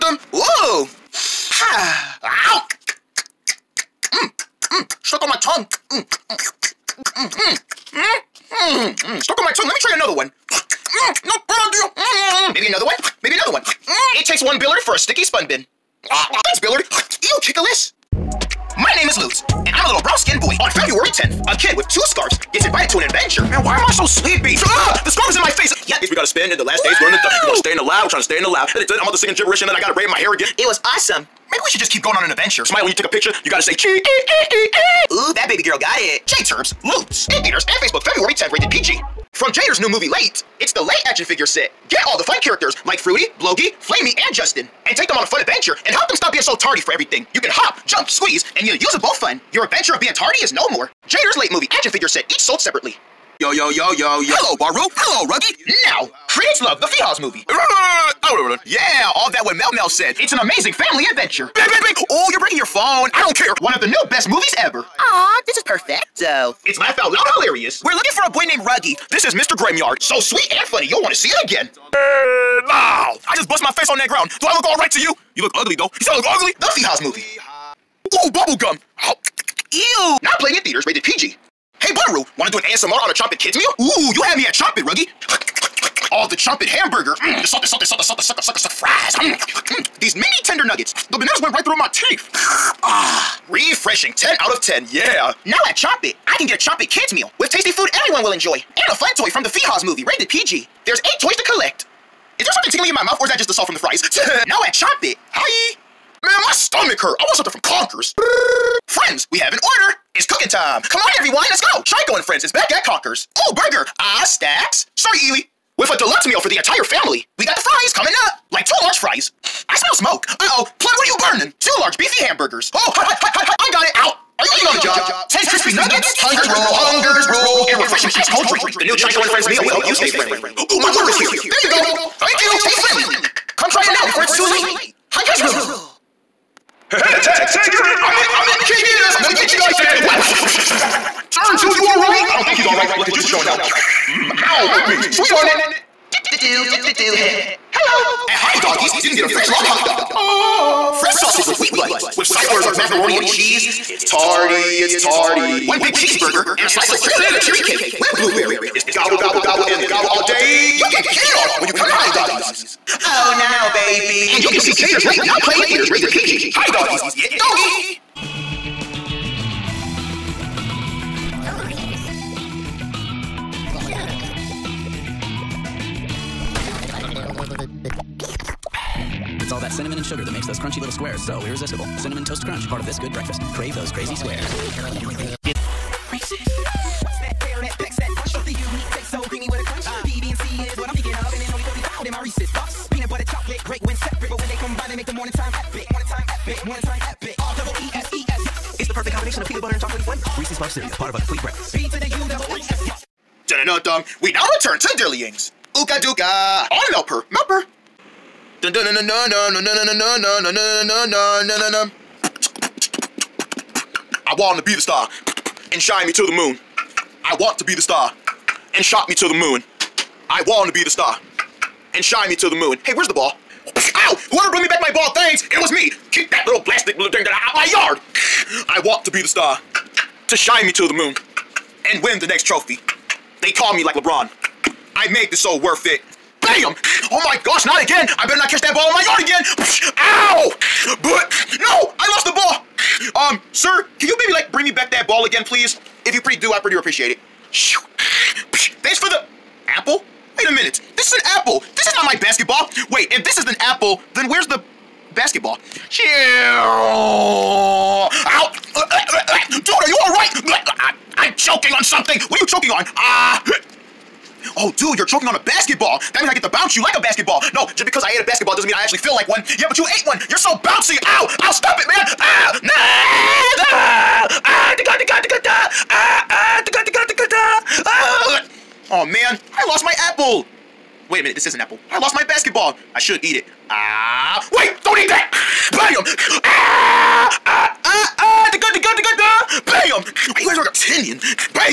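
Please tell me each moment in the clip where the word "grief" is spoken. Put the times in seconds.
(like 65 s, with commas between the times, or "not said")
not said.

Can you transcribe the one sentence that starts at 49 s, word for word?
Your adventure of being tardy is no more.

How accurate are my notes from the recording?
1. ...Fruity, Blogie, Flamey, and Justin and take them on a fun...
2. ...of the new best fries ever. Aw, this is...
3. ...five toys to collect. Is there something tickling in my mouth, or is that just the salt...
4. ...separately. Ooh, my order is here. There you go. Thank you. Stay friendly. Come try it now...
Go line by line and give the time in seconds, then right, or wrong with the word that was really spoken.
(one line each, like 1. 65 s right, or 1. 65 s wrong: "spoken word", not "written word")
1. 42 s right
2. 63 s wrong: "movies", not "fries"
3. 100 s wrong: "eight", not "five"
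4. 130 s wrong: "friendly", not "separately".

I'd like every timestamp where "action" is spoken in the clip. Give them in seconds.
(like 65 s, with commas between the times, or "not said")
41 s, 51 s.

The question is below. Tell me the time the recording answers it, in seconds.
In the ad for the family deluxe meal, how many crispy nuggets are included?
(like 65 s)
125 s.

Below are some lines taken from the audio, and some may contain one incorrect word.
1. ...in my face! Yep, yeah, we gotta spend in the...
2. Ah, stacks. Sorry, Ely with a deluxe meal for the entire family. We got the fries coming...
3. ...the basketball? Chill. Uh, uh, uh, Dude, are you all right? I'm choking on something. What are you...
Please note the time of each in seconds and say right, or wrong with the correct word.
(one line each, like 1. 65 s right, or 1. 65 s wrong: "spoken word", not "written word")
1. 25 s right
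2. 113 s right
3. 254 s right.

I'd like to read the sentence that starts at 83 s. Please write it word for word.
Ooh, you had me at Chompin', Ruggy.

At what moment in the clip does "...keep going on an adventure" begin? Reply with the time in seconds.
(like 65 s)
31 s.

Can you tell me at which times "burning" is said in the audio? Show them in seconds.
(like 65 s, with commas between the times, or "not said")
121 s.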